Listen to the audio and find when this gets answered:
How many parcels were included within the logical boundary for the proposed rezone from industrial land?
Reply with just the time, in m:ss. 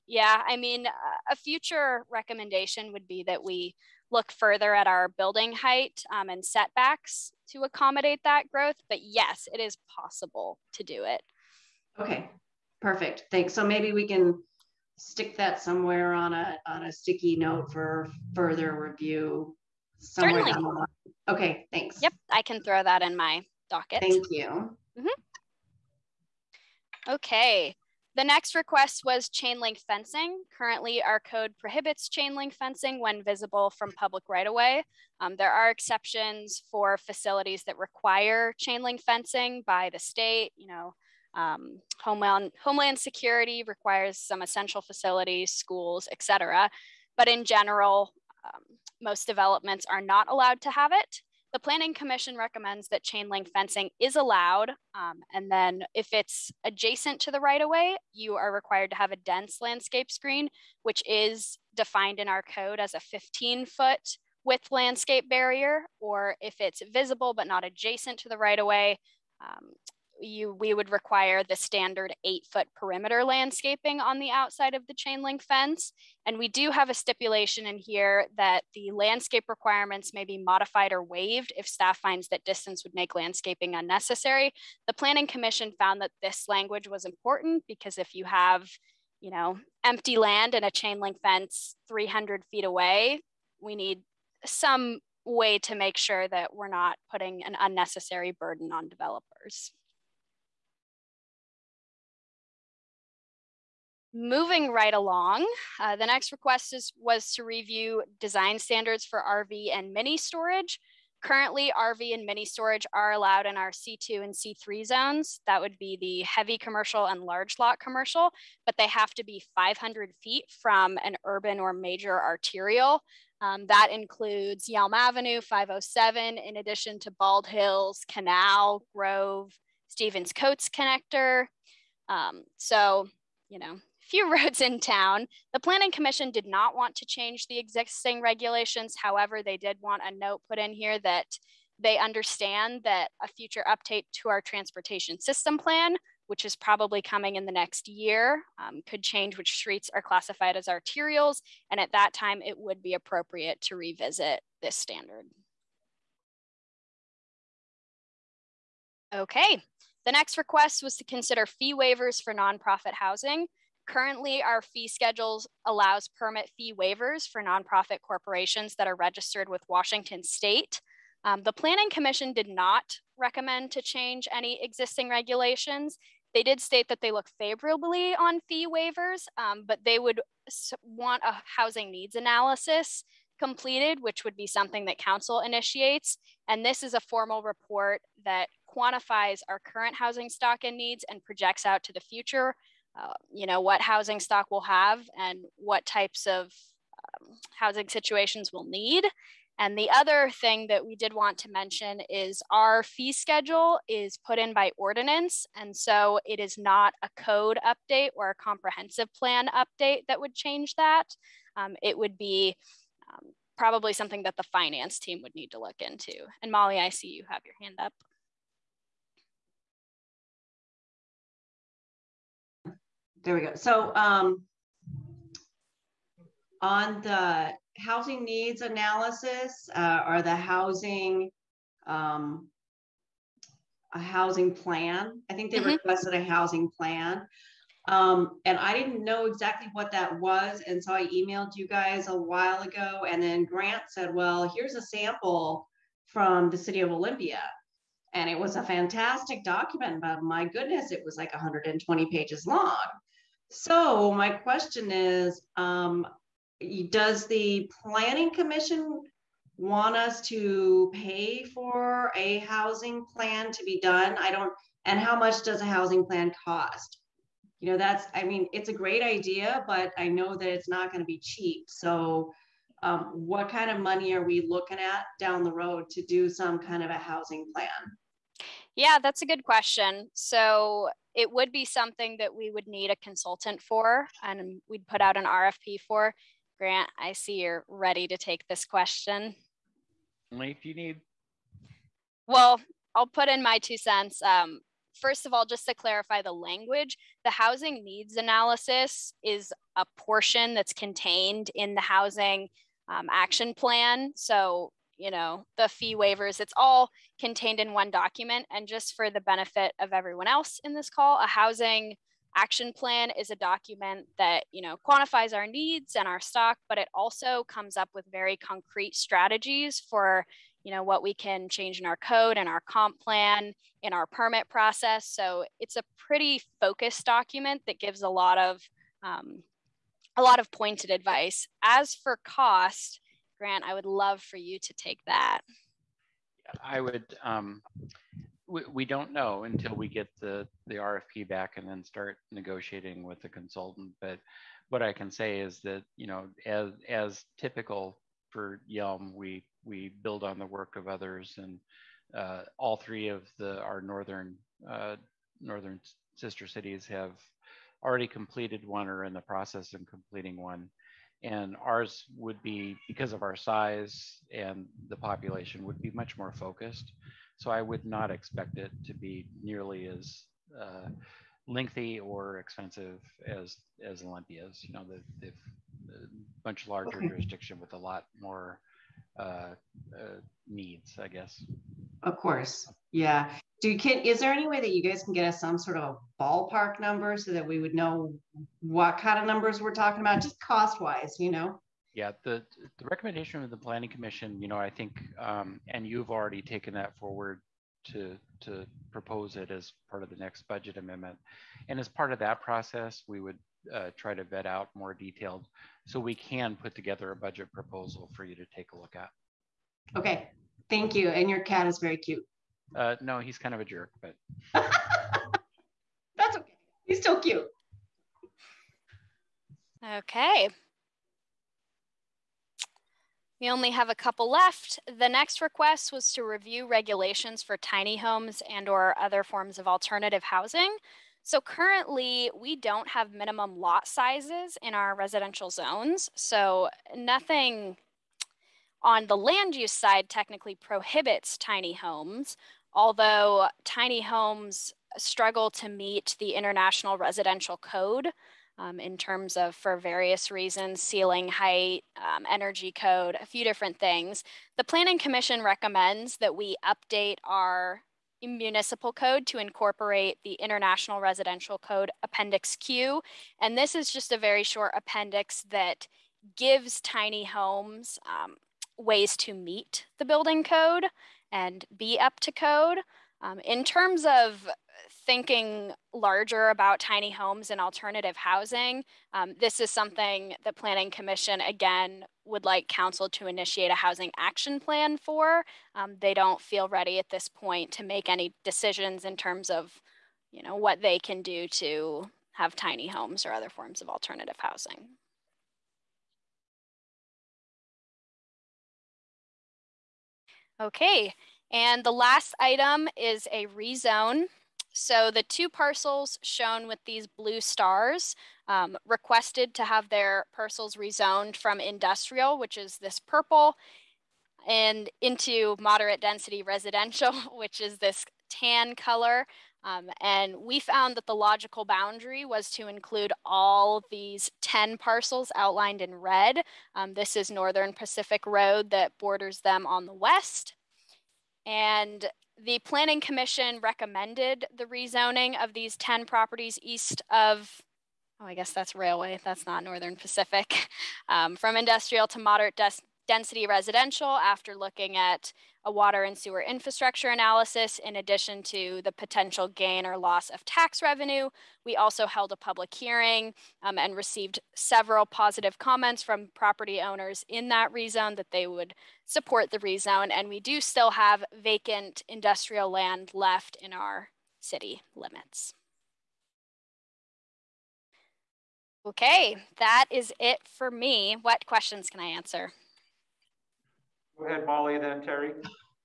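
8:44.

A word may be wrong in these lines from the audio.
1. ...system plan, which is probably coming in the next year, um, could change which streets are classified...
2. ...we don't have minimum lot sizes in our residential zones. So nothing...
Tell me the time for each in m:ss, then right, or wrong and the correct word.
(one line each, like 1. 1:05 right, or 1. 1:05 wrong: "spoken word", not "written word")
1. 2:25 right
2. 7:12 right.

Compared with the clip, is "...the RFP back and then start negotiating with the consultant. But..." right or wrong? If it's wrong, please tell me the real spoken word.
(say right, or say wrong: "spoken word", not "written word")
right.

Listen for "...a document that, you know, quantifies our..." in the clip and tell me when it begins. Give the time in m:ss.
5:13.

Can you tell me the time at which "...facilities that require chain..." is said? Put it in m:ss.
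0:36.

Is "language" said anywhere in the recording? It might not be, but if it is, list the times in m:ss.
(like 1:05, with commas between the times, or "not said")
1:26, 4:56.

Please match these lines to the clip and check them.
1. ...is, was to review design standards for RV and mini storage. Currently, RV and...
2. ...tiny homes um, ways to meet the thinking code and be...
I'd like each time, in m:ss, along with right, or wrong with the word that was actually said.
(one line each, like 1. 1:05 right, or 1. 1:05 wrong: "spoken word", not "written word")
1. 1:46 right
2. 7:46 wrong: "building", not "thinking".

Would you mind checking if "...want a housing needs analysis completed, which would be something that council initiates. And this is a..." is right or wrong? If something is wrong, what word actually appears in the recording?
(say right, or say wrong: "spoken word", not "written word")
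right.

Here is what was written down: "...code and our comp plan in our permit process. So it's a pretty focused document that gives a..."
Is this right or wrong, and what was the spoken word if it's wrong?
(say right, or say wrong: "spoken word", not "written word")
right.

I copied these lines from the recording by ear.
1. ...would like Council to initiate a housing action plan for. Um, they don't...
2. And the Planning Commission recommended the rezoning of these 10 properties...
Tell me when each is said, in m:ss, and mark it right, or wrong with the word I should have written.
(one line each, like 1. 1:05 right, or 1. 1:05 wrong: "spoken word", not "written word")
1. 8:02 right
2. 8:51 right.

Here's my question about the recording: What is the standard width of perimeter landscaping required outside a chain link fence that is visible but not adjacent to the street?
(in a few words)
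8 feet.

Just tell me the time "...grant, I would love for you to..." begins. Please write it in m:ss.
5:33.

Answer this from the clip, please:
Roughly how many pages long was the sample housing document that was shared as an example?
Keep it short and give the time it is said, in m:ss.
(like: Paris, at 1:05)
120, at 4:11.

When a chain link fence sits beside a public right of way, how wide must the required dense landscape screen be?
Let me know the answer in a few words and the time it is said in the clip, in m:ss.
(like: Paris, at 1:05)
15 feet, at 1:02.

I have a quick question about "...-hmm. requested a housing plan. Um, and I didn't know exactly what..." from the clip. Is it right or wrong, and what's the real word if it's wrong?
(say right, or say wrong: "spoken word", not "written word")
right.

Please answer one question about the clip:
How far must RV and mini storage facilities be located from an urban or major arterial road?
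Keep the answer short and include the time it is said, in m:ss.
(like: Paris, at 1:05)
500 feet, at 1:59.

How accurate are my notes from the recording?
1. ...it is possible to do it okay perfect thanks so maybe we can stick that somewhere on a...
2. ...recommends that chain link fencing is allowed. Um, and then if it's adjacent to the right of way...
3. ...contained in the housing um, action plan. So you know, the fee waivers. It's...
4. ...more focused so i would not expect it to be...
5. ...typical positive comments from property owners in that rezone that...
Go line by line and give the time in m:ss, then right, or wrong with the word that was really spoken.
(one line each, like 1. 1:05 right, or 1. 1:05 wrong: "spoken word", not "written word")
1. 0:09 right
2. 0:52 right
3. 5:00 right
4. 6:06 right
5. 9:14 wrong: "several", not "typical".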